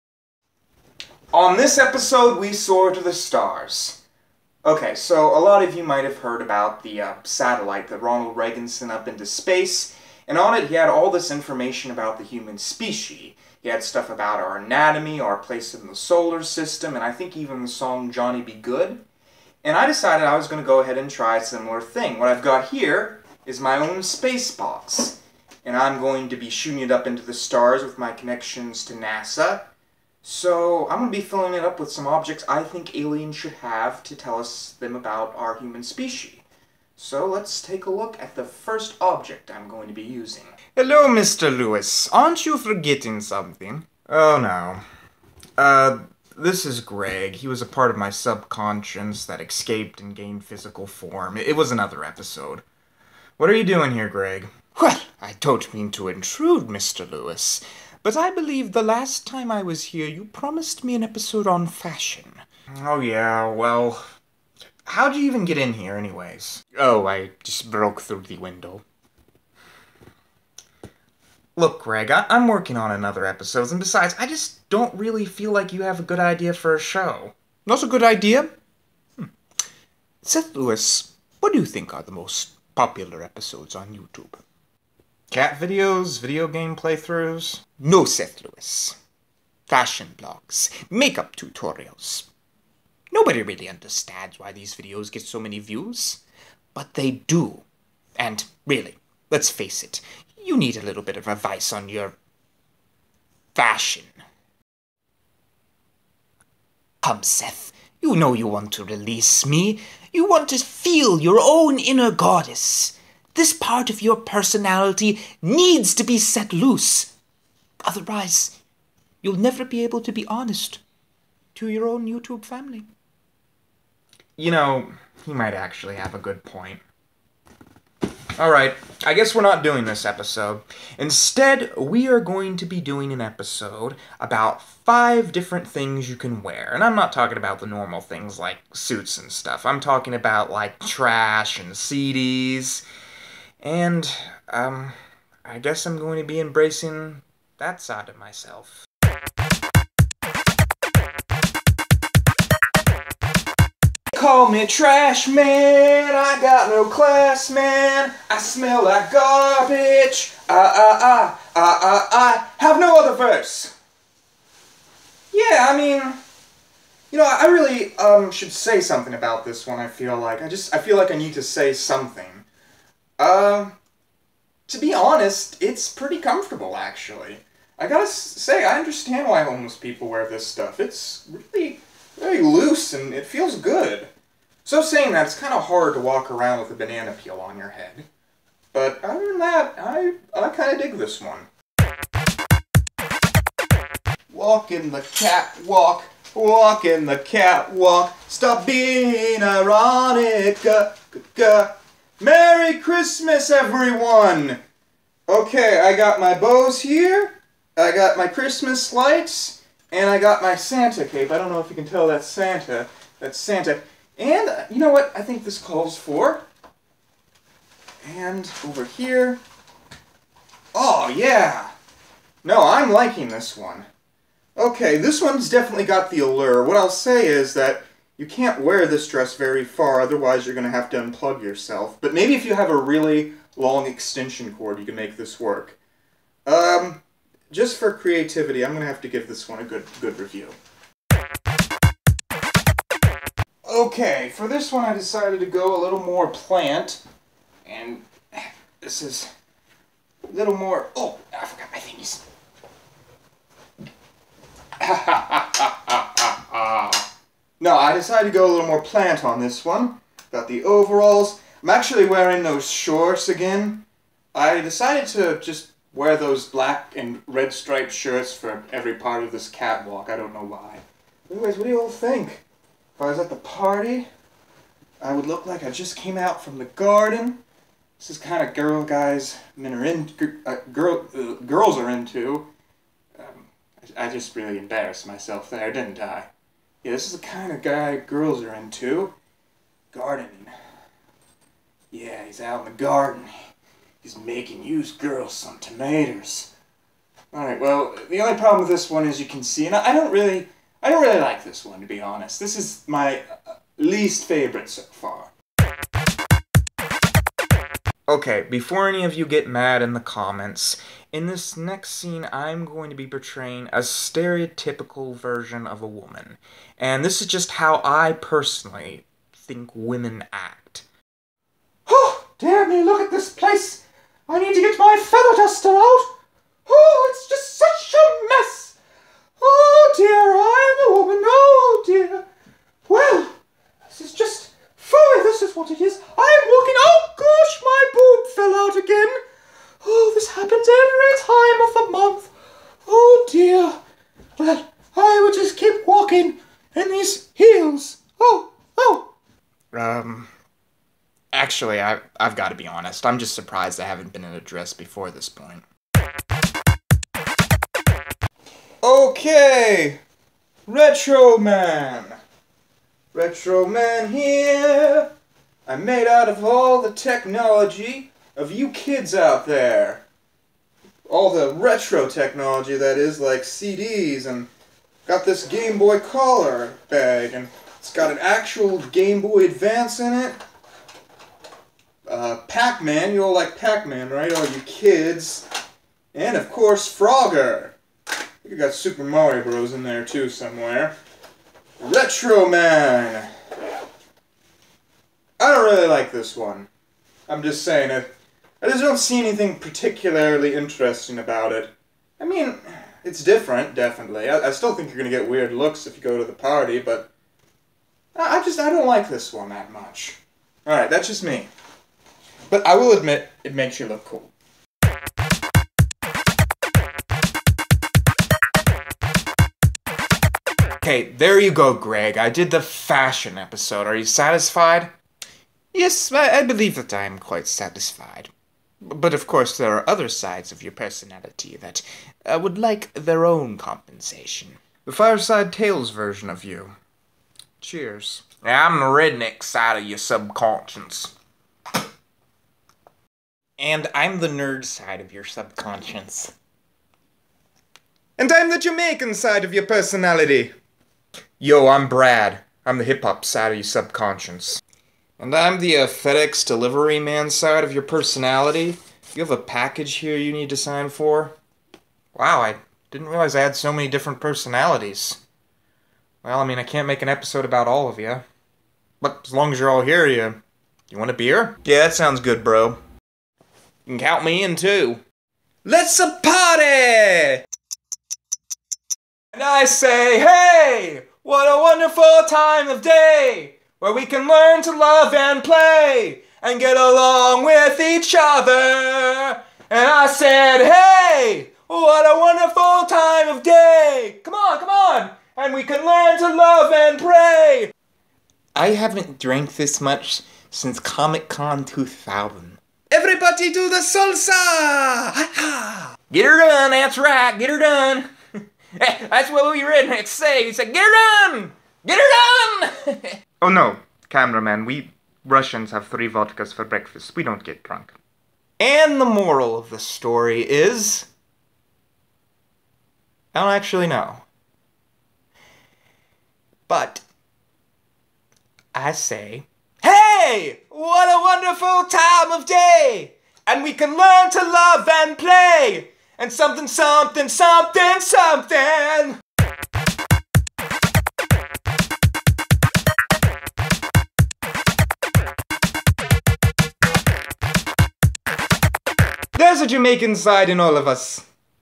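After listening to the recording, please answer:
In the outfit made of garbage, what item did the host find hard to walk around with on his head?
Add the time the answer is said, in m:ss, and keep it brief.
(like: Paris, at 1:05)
A banana peel, at 3:06.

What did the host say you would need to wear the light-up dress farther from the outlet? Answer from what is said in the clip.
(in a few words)
A really long extension cord.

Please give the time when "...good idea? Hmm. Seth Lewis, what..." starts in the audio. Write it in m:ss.
1:17.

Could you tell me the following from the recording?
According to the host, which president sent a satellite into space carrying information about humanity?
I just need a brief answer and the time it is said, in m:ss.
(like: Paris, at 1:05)
Ronald Reagan, at 0:08.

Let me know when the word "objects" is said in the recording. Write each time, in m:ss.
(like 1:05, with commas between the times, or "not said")
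0:32, 0:39.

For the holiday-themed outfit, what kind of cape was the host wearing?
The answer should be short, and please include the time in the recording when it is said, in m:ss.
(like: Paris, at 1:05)
Santa cape, at 3:30.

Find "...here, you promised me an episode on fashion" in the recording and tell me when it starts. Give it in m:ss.
0:59.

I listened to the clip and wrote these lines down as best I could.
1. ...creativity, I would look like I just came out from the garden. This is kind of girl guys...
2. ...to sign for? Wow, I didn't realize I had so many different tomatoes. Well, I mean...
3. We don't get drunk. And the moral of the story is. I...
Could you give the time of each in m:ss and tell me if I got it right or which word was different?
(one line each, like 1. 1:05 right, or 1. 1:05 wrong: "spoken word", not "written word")
1. 4:33 wrong: "party", not "creativity"
2. 7:40 wrong: "personalities", not "tomatoes"
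3. 8:37 right.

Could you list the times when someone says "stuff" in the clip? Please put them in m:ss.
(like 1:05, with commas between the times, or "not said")
0:13, 2:19, 3:00.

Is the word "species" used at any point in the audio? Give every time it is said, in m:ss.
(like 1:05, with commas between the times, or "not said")
0:12, 0:35.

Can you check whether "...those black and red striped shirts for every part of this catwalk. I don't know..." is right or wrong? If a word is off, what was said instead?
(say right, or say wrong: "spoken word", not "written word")
right.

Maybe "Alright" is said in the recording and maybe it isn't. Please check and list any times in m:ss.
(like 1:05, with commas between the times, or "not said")
2:08, 4:57.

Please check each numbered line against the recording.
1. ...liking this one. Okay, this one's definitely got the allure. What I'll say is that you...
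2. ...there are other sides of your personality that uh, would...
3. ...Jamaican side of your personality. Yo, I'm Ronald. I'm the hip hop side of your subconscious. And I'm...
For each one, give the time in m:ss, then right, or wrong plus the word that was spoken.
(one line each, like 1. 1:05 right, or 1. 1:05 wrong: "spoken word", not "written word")
1. 3:42 right
2. 7:09 right
3. 7:28 wrong: "Brad", not "Ronald".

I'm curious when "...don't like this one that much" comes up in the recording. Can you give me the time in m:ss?
6:48.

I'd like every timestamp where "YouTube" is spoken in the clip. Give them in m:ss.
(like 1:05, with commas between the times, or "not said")
1:23, 2:02.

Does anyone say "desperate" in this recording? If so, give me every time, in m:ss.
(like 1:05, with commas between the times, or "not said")
not said.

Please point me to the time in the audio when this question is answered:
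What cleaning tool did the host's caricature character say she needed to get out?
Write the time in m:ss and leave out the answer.
5:25.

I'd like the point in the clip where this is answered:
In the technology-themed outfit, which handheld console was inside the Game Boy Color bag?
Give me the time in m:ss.
6:18.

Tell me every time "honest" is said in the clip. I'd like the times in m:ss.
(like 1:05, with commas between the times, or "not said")
2:00, 2:54, 5:02, 5:52.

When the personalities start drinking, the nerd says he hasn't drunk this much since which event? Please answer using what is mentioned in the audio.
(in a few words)
Comic Con 2000.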